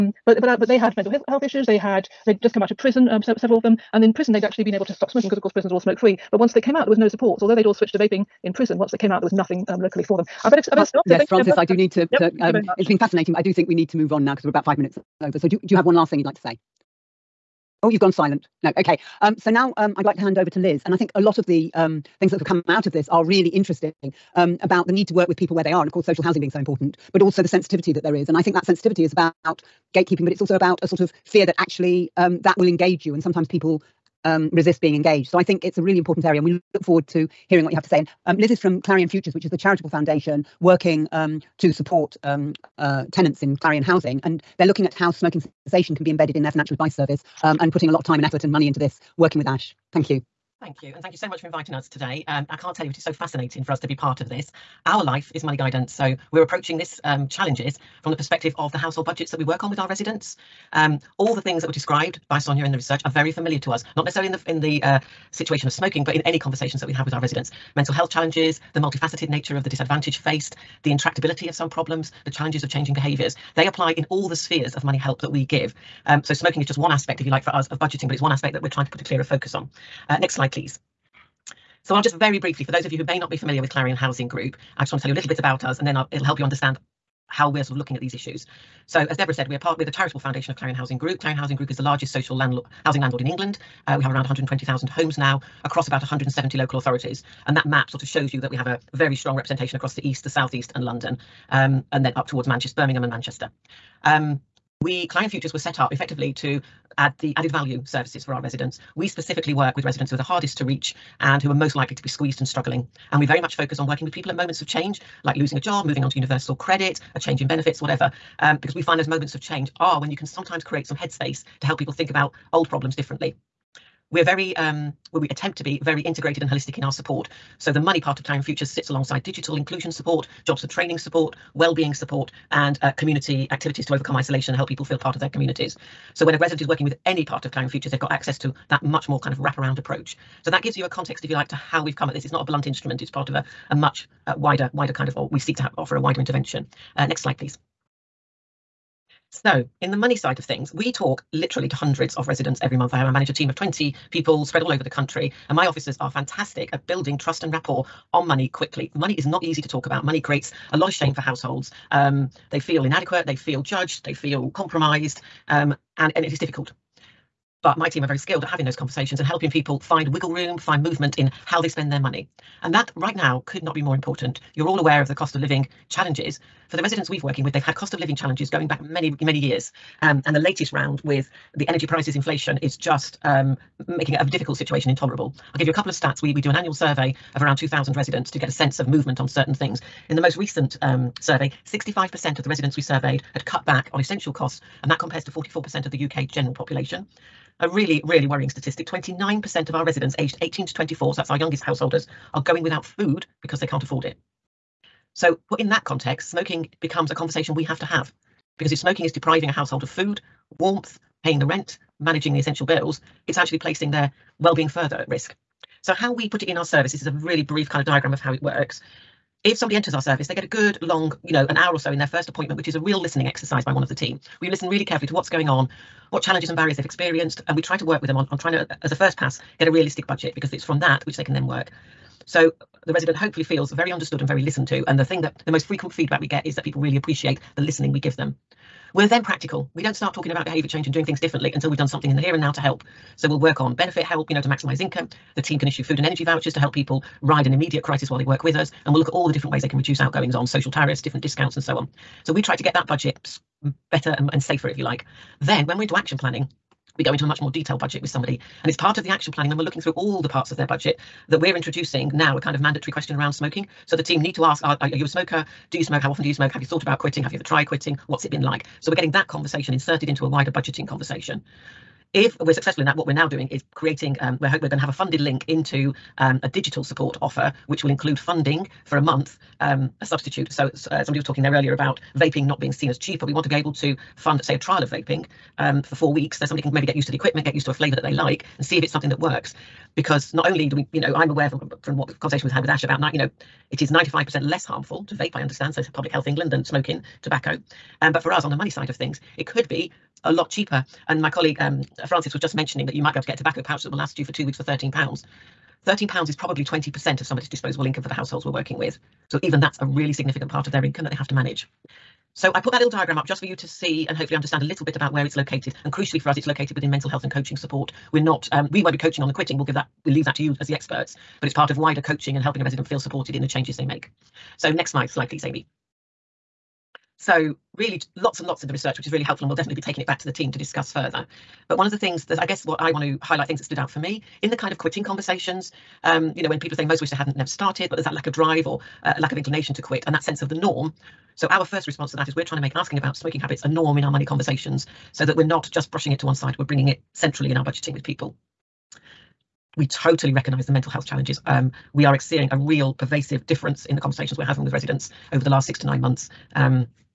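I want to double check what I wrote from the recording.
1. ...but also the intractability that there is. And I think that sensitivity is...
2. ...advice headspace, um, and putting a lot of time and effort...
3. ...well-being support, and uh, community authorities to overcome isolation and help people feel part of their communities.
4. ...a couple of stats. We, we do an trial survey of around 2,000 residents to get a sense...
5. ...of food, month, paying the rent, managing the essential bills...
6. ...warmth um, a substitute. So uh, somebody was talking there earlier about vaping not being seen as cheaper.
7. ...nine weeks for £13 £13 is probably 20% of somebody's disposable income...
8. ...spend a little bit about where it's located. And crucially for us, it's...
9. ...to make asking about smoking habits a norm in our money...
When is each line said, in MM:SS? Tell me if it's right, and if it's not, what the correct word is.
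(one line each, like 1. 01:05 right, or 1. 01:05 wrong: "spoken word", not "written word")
1. 00:27 wrong: "sensitivity", not "intractability"
2. 00:46 wrong: "service", not "headspace"
3. 02:11 wrong: "activities", not "authorities"
4. 03:05 wrong: "annual", not "trial"
5. 03:29 wrong: "warmth", not "month"
6. 04:38 wrong: "month", not "warmth"
7. 05:04 wrong: "two", not "nine"
8. 05:14 wrong: "understand", not "spend"
9. 05:42 right.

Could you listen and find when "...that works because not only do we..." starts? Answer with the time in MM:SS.
04:49.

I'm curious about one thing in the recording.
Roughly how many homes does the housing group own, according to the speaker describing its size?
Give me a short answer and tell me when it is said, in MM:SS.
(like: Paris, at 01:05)
120,000, at 01:34.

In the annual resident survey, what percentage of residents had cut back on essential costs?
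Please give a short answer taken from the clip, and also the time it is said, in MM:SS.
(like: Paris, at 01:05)
65%, at 03:11.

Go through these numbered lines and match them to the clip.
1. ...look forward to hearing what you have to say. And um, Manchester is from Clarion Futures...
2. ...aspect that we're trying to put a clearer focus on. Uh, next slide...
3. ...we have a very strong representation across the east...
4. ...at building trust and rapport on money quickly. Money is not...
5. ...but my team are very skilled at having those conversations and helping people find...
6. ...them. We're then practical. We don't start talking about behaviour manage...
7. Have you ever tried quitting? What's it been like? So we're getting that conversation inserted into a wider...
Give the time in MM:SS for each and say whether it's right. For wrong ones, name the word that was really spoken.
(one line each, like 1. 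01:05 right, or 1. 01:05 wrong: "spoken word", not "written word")
1. 00:36 wrong: "Liz", not "Manchester"
2. 01:18 right
3. 01:38 right
4. 02:36 right
5. 02:47 right
6. 03:58 wrong: "change", not "manage"
7. 04:27 right.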